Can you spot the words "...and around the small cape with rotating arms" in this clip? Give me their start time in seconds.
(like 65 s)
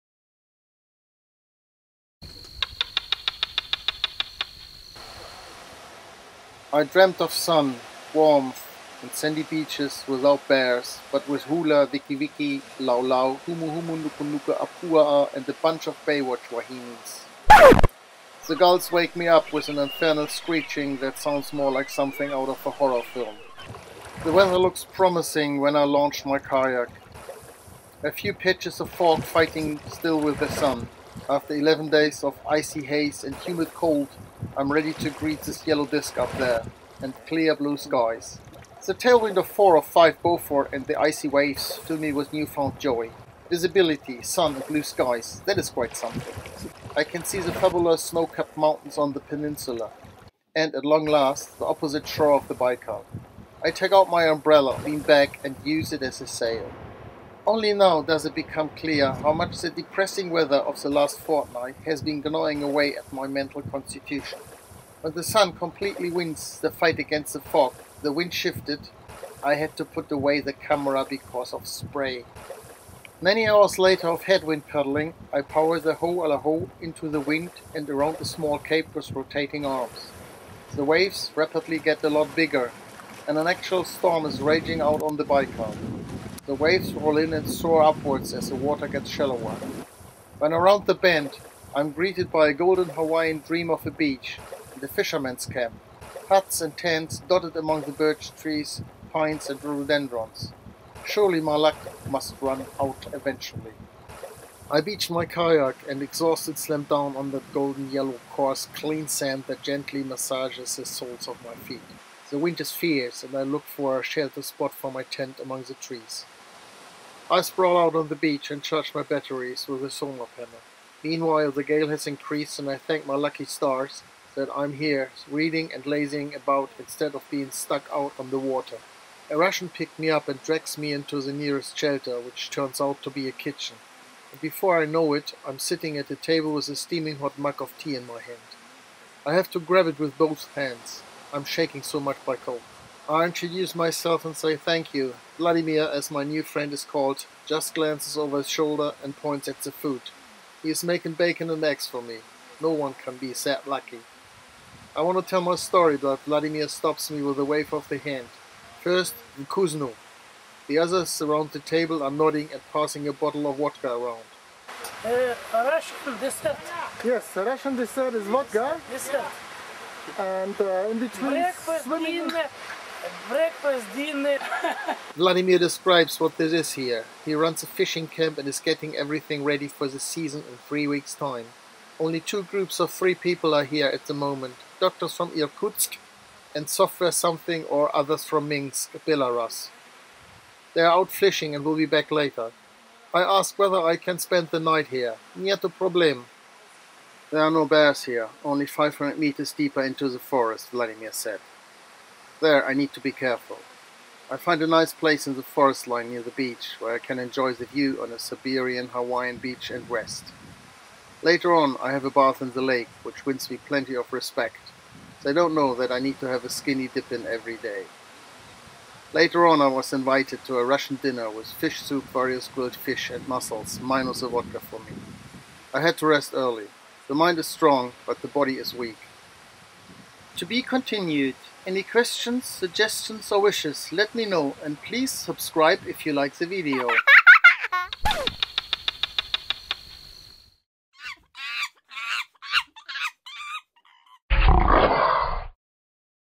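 77 s.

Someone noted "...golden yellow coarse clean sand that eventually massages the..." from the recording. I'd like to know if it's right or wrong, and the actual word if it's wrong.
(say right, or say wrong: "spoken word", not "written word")
wrong: "gently", not "eventually".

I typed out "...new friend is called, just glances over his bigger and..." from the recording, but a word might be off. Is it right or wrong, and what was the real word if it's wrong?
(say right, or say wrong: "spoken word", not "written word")
wrong: "shoulder", not "bigger".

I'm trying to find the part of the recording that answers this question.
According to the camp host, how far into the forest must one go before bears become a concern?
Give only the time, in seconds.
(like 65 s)
198 s.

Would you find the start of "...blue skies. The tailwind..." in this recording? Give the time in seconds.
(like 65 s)
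37 s.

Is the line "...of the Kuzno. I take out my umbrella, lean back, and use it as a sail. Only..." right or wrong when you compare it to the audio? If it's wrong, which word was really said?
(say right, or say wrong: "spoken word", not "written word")
wrong: "Baikal", not "Kuzno".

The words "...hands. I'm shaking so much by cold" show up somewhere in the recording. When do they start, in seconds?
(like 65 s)
140 s.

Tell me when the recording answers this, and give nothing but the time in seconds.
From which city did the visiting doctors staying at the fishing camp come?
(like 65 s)
185 s.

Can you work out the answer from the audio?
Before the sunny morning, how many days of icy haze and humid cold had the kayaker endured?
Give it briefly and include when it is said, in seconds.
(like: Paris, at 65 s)
11, at 31 s.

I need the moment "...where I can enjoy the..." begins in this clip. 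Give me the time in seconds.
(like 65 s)
206 s.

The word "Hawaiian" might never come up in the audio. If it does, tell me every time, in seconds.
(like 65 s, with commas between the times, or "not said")
92 s, 208 s.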